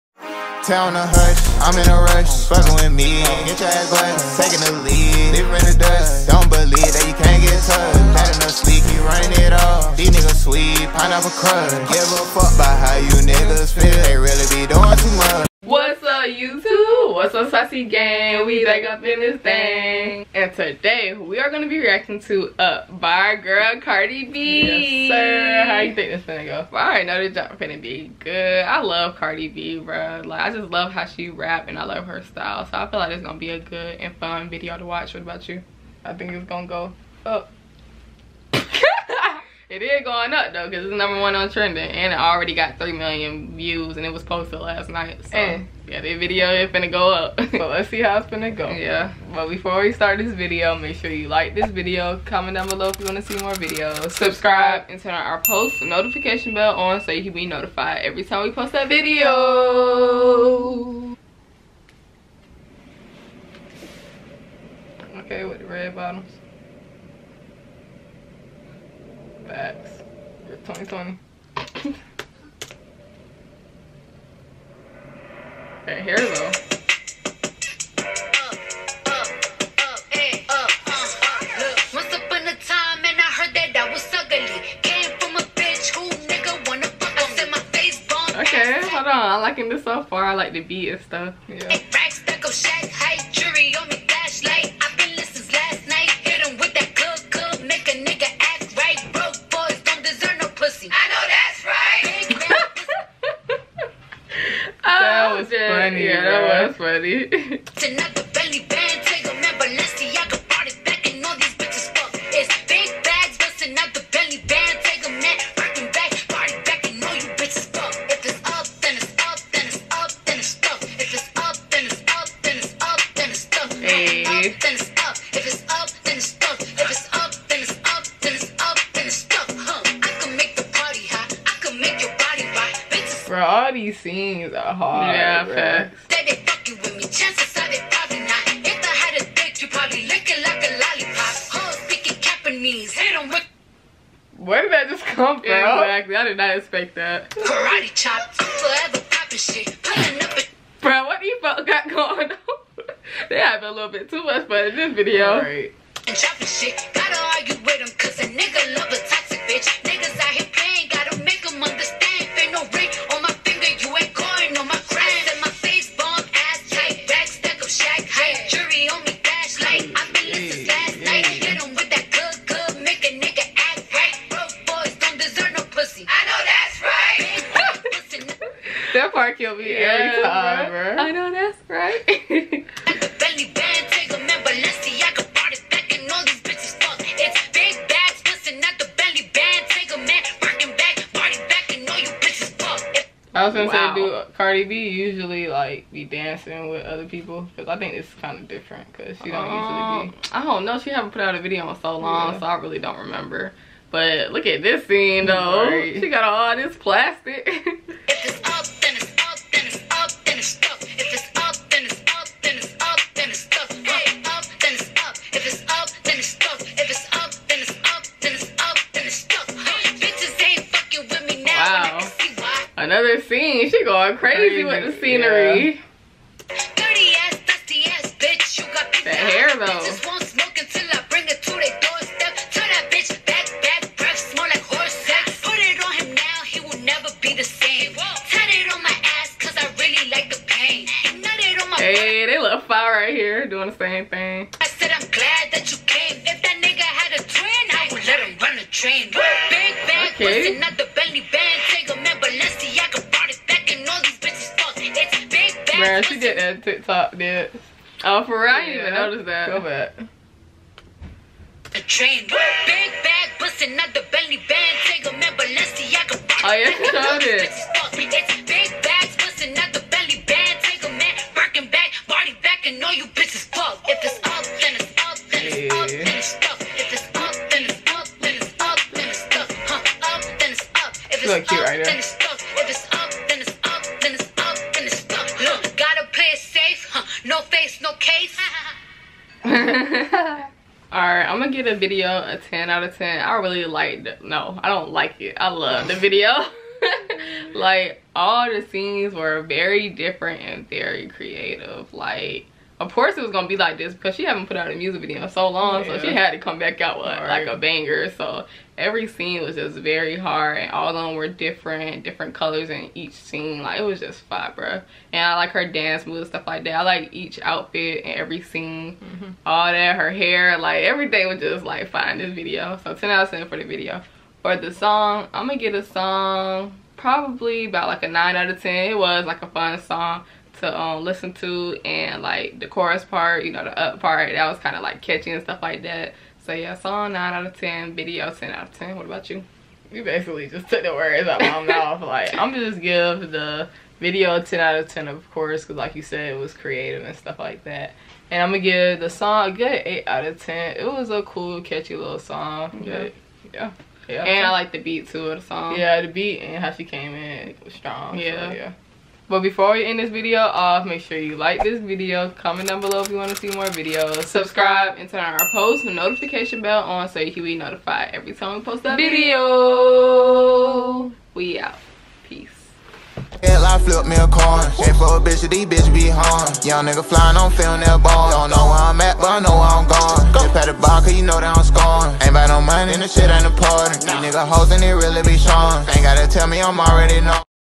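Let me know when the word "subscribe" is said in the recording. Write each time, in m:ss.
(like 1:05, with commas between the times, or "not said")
0:54, 6:04.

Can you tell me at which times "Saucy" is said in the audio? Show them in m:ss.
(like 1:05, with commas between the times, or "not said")
0:17.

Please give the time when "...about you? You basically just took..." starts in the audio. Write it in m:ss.
5:39.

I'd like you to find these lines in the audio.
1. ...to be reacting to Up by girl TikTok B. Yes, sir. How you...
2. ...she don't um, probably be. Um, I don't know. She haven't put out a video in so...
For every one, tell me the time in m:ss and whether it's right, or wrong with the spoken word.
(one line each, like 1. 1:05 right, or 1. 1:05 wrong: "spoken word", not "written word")
1. 0:21 wrong: "Cardi", not "TikTok"
2. 3:19 wrong: "usually", not "probably".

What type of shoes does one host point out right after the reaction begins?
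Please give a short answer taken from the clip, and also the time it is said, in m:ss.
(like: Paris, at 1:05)
red bottoms, at 1:05.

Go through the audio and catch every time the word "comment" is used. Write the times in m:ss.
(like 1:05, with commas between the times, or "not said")
0:52, 6:02.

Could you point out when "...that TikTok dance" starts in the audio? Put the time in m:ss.
4:16.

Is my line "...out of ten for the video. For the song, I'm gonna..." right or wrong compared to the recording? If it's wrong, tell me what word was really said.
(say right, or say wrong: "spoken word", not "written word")
right.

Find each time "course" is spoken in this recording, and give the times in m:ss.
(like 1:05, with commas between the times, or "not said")
5:02, 5:45.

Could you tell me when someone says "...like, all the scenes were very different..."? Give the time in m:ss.
4:57.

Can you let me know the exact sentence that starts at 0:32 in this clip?
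So I feel like it's going to be a good and fun video to watch.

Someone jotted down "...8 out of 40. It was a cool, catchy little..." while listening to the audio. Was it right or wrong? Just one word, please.
wrong.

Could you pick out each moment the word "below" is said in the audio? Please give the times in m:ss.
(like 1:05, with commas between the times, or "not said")
0:52, 6:02.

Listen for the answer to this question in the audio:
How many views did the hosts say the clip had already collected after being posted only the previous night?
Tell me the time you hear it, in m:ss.
0:42.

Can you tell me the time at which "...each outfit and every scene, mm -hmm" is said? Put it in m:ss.
5:17.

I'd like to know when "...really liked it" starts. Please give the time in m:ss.
4:53.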